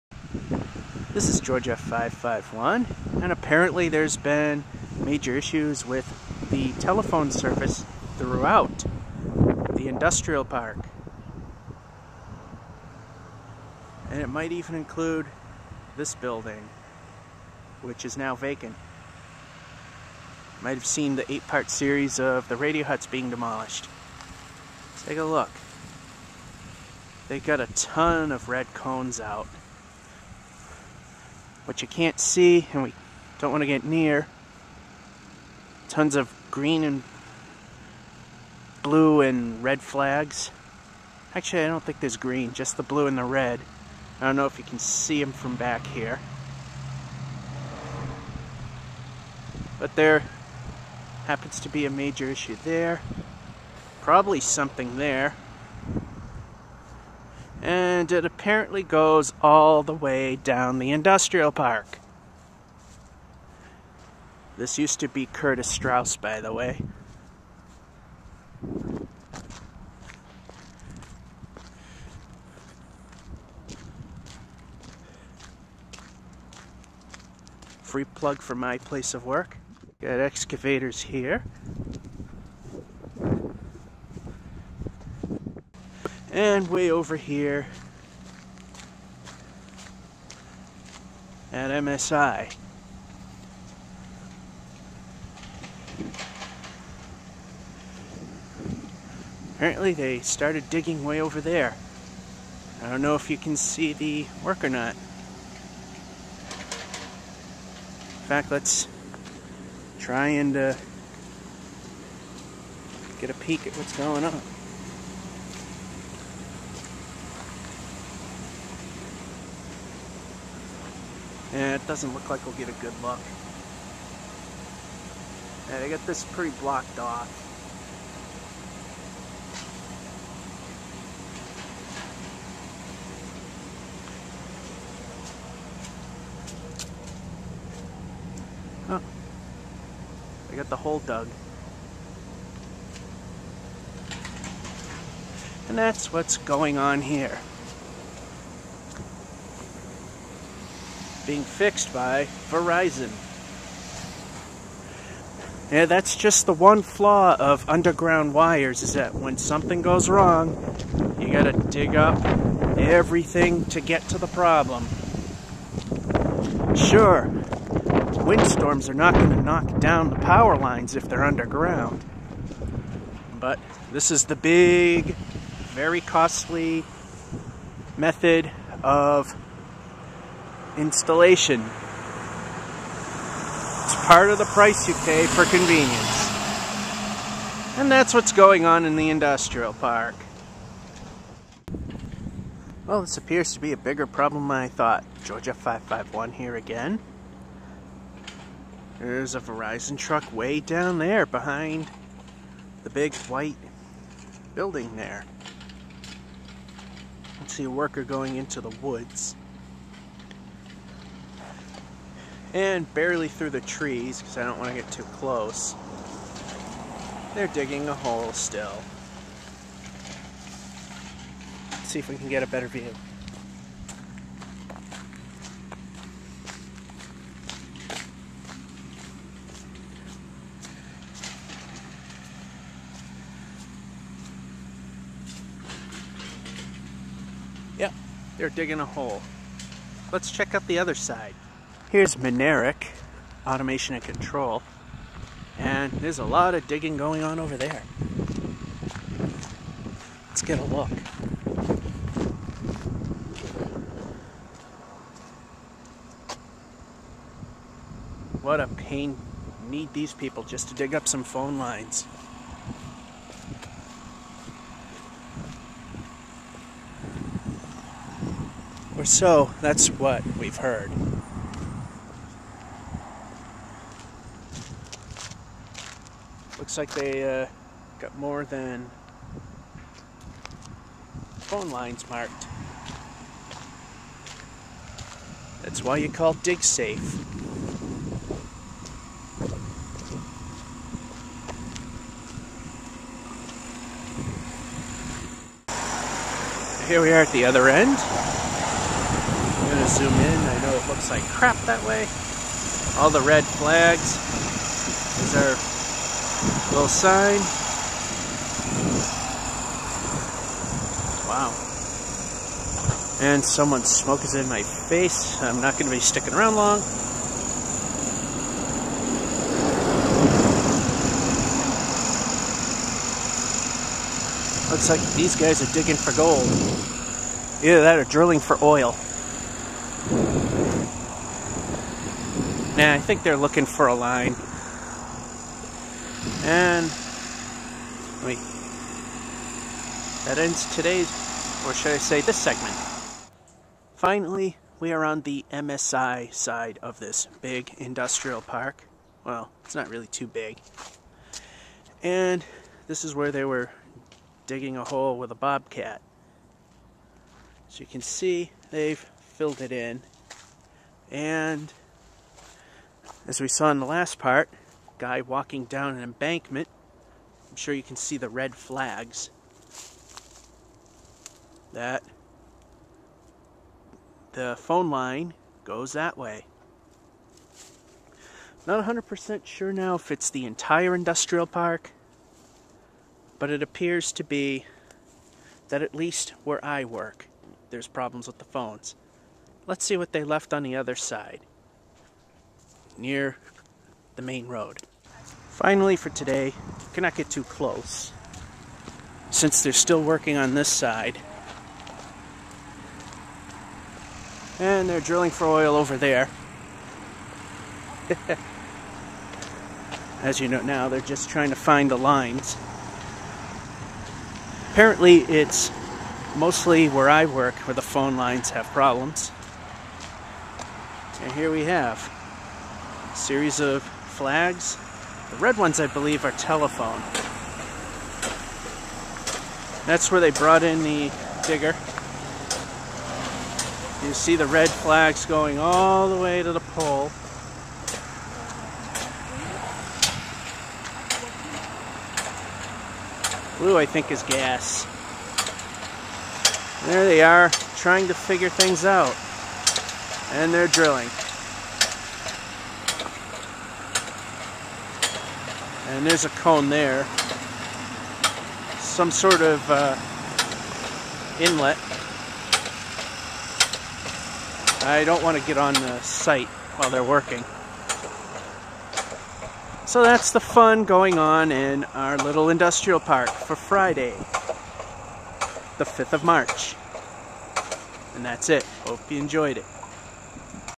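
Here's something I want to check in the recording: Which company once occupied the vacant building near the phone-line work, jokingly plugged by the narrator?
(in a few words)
Curtis Straus.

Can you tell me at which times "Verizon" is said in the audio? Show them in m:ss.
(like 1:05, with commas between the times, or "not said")
2:32, 3:19.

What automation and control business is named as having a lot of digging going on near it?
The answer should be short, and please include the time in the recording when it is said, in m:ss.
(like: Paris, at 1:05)
Minarik, at 4:02.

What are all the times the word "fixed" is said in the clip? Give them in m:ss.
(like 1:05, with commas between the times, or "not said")
2:31.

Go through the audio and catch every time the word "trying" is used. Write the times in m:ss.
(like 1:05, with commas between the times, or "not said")
6:51, 7:27.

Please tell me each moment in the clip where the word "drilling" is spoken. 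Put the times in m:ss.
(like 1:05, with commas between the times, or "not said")
5:28, 6:44, 7:30.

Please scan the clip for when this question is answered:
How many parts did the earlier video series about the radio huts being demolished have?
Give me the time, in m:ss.
0:21.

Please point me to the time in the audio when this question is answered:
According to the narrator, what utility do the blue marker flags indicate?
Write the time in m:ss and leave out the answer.
7:24.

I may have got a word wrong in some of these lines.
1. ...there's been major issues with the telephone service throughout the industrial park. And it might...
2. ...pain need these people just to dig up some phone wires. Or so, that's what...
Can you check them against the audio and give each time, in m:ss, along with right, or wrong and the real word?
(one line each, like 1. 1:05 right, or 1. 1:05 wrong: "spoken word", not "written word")
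1. 0:03 right
2. 4:18 wrong: "lines", not "wires".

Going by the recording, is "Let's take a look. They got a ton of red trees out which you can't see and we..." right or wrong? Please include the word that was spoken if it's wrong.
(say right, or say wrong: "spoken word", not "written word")
wrong: "cones", not "trees".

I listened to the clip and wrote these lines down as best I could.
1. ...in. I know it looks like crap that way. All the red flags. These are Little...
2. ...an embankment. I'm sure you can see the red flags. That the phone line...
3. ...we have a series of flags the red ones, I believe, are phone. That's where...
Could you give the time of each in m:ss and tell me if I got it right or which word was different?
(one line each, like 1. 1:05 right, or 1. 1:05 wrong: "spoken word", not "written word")
1. 5:00 right
2. 6:05 right
3. 7:01 wrong: "telephone", not "phone".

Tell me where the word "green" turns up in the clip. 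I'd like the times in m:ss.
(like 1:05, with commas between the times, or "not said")
0:36, 0:42.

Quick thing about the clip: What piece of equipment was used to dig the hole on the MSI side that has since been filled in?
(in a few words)
Bobcat.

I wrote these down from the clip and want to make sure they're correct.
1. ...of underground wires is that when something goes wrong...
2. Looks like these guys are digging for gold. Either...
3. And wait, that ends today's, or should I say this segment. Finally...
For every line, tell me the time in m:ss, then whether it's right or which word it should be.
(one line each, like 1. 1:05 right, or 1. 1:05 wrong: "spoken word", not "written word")
1. 2:37 right
2. 5:24 right
3. 5:36 right.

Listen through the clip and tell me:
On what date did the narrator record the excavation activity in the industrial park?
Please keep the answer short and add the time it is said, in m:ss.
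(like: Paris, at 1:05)
Friday, March 5, at 7:53.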